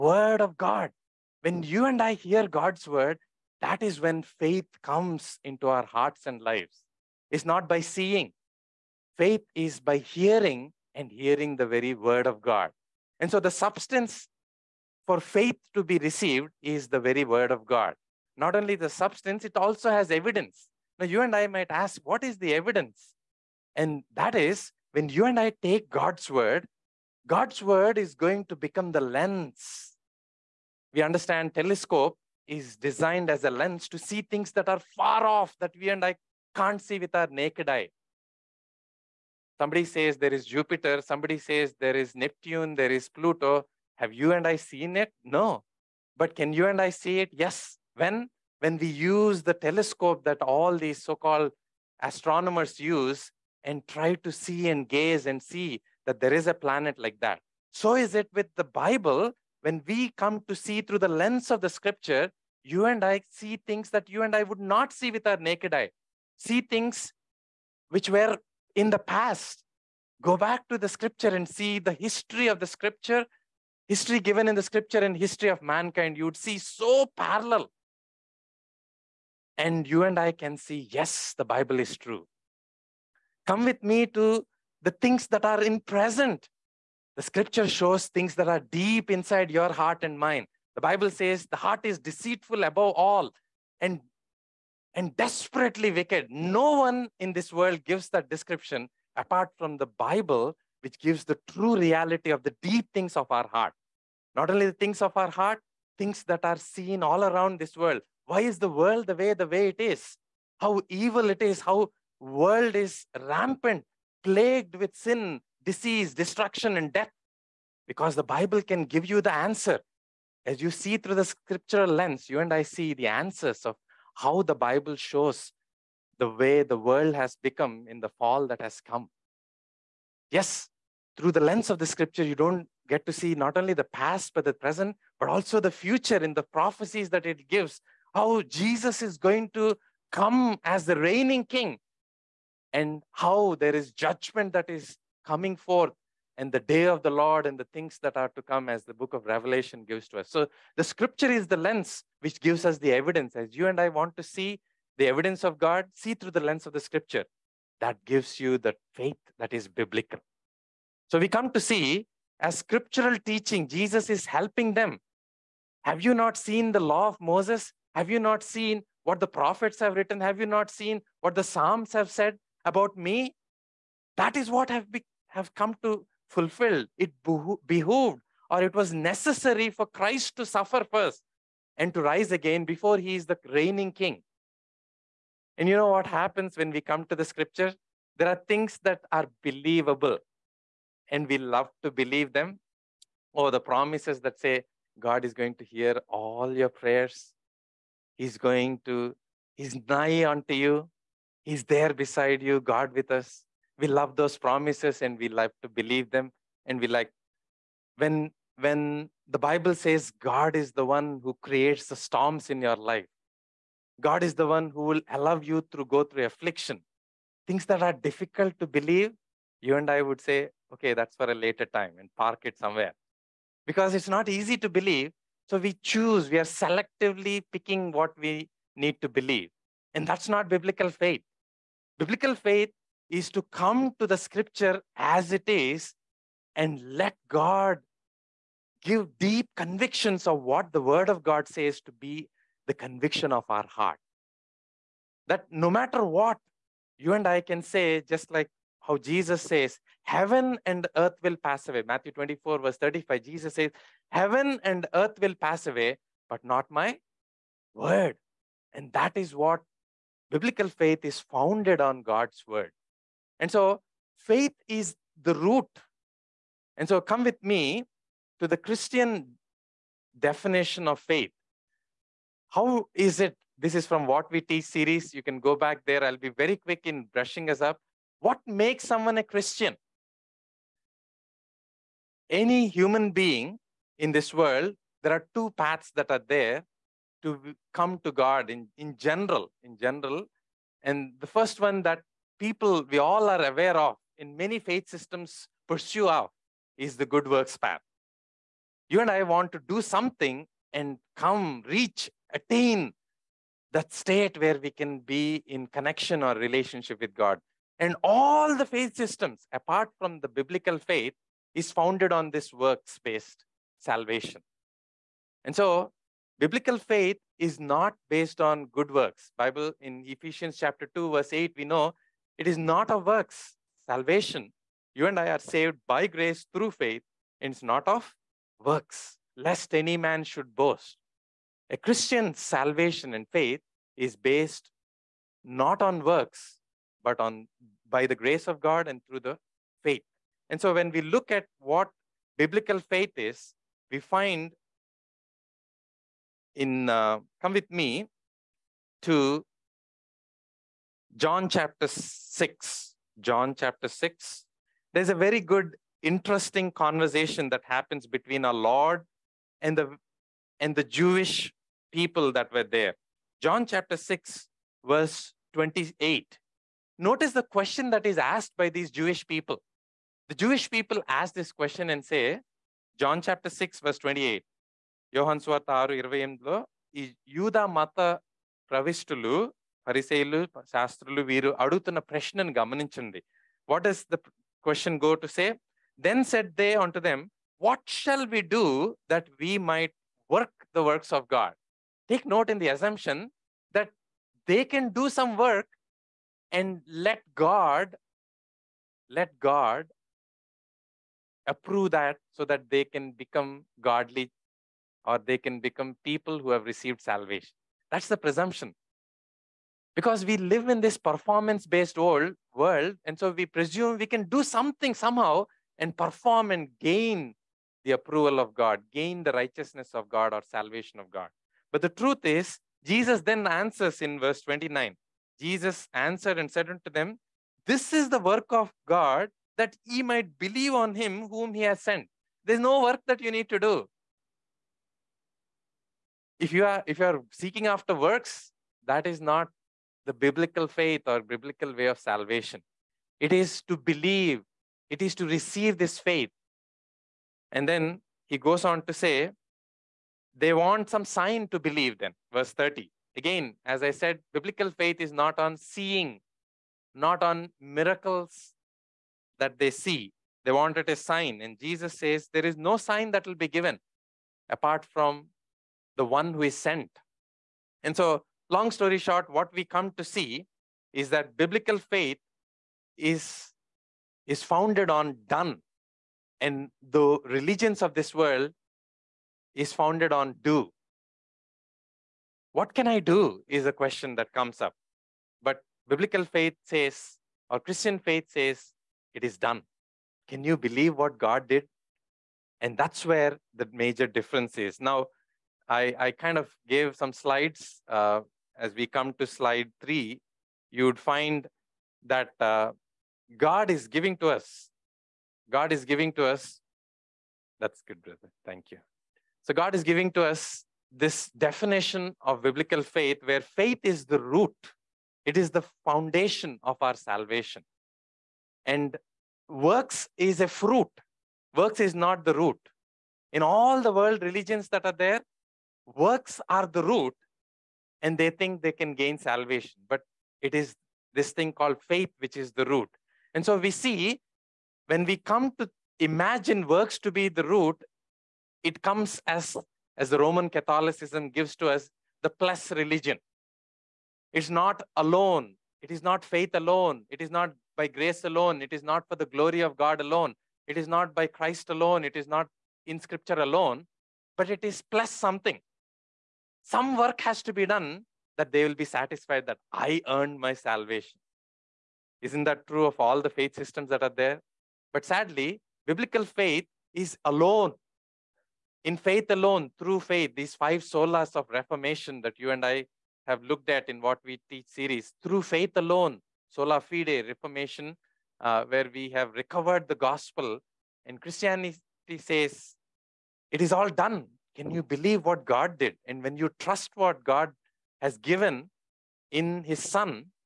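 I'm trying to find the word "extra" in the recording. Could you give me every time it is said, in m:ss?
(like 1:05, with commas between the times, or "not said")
not said.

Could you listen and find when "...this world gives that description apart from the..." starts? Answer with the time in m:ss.
1:37.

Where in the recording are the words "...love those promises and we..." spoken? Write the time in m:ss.
3:23.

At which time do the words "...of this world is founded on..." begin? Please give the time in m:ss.
7:57.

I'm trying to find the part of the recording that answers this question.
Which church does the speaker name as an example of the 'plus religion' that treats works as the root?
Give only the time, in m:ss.
9:00.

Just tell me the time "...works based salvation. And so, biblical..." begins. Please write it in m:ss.
5:12.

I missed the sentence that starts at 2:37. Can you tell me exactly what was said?
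That gives you the faith that is biblical.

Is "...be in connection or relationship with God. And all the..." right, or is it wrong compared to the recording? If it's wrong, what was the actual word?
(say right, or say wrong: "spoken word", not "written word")
right.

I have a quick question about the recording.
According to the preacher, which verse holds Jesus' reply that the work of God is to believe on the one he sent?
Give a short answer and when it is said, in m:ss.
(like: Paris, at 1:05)
Verse 29, at 7:04.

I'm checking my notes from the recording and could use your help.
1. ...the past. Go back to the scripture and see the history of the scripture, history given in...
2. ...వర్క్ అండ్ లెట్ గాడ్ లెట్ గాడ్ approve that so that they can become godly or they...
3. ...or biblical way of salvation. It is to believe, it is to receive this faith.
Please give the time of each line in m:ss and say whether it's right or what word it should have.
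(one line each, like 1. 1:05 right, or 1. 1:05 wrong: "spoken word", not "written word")
1. 1:08 right
2. 6:35 right
3. 7:21 right.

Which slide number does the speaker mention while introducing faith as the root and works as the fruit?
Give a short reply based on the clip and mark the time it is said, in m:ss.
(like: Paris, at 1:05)
3, at 8:19.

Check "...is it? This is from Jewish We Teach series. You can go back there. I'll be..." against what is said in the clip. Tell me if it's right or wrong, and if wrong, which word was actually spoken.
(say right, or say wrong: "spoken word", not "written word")
wrong: "What", not "Jewish".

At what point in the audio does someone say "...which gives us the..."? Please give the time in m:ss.
2:32.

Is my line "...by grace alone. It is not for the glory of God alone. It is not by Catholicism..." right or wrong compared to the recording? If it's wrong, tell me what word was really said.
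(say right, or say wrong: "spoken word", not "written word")
wrong: "Christ", not "Catholicism".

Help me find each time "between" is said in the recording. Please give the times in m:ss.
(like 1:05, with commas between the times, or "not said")
5:58.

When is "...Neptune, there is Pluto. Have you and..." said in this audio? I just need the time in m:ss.
0:42.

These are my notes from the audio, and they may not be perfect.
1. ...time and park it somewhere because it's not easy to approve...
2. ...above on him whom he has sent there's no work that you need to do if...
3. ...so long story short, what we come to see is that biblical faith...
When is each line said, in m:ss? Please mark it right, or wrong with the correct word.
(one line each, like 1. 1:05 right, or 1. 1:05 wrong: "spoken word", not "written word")
1. 3:41 wrong: "believe", not "approve"
2. 7:10 wrong: "believe", not "above"
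3. 7:47 right.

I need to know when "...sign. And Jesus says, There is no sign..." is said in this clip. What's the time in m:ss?
7:40.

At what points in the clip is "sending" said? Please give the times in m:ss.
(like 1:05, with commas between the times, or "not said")
not said.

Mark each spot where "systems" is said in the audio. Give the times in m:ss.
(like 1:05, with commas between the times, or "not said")
4:54, 5:08, 9:23.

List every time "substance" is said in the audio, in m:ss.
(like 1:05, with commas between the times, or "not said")
0:13, 0:18.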